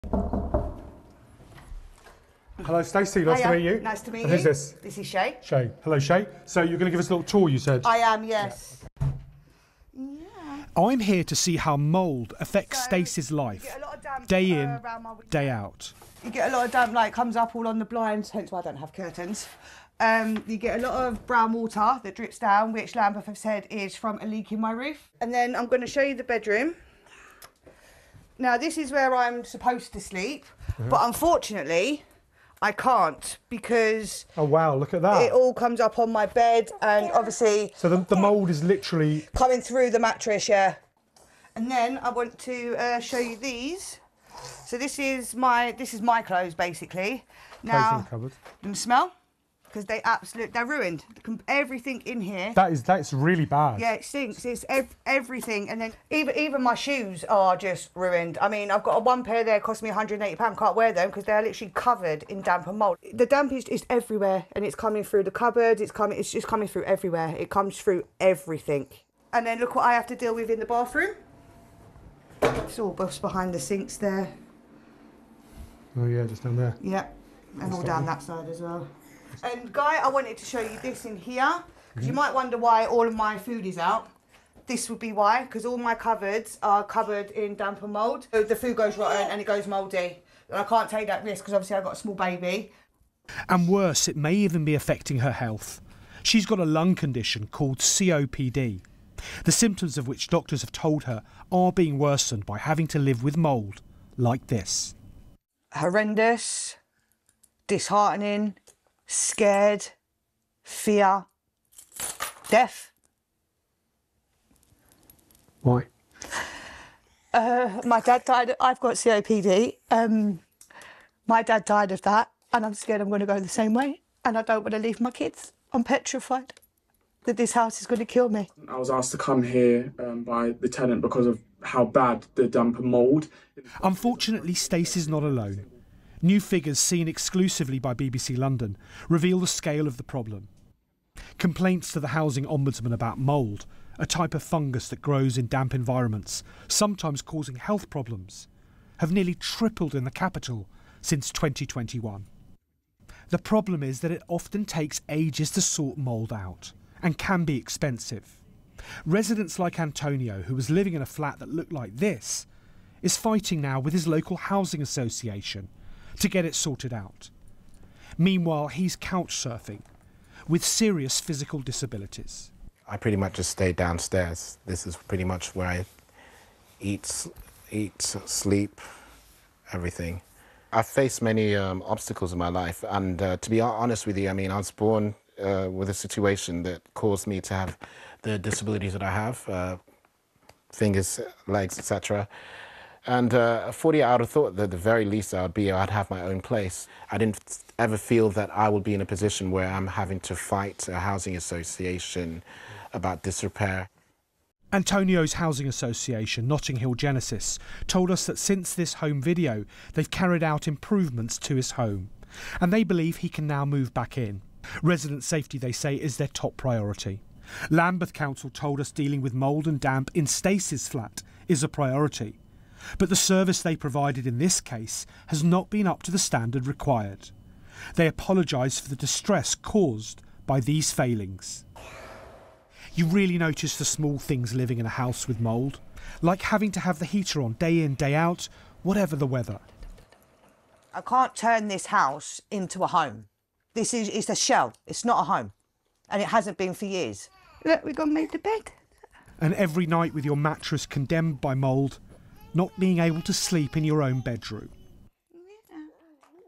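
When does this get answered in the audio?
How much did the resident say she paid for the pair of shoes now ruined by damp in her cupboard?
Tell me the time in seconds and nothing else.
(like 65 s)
59 s.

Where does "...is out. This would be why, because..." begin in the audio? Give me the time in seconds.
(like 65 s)
83 s.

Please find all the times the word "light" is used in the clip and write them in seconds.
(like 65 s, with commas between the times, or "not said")
16 s.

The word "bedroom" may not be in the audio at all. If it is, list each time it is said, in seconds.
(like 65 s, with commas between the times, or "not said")
26 s, 254 s.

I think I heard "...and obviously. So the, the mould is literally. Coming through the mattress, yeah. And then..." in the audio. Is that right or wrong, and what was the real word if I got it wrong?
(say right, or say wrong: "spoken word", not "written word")
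right.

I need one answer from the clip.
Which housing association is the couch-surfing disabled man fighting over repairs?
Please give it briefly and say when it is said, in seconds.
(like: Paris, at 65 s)
Notting Hill Genesis, at 206 s.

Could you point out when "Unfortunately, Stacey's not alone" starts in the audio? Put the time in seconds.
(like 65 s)
133 s.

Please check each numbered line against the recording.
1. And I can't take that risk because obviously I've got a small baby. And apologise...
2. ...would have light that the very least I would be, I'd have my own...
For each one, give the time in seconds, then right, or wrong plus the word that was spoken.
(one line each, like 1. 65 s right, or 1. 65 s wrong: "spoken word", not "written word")
1. 90 s wrong: "worse", not "apologise"
2. 194 s wrong: "thought", not "light".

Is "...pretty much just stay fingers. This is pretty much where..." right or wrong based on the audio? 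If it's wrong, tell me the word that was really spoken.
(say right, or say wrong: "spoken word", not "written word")
wrong: "downstairs", not "fingers".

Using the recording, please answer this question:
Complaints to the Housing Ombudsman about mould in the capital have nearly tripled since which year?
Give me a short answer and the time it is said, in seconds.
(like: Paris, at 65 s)
2021, at 151 s.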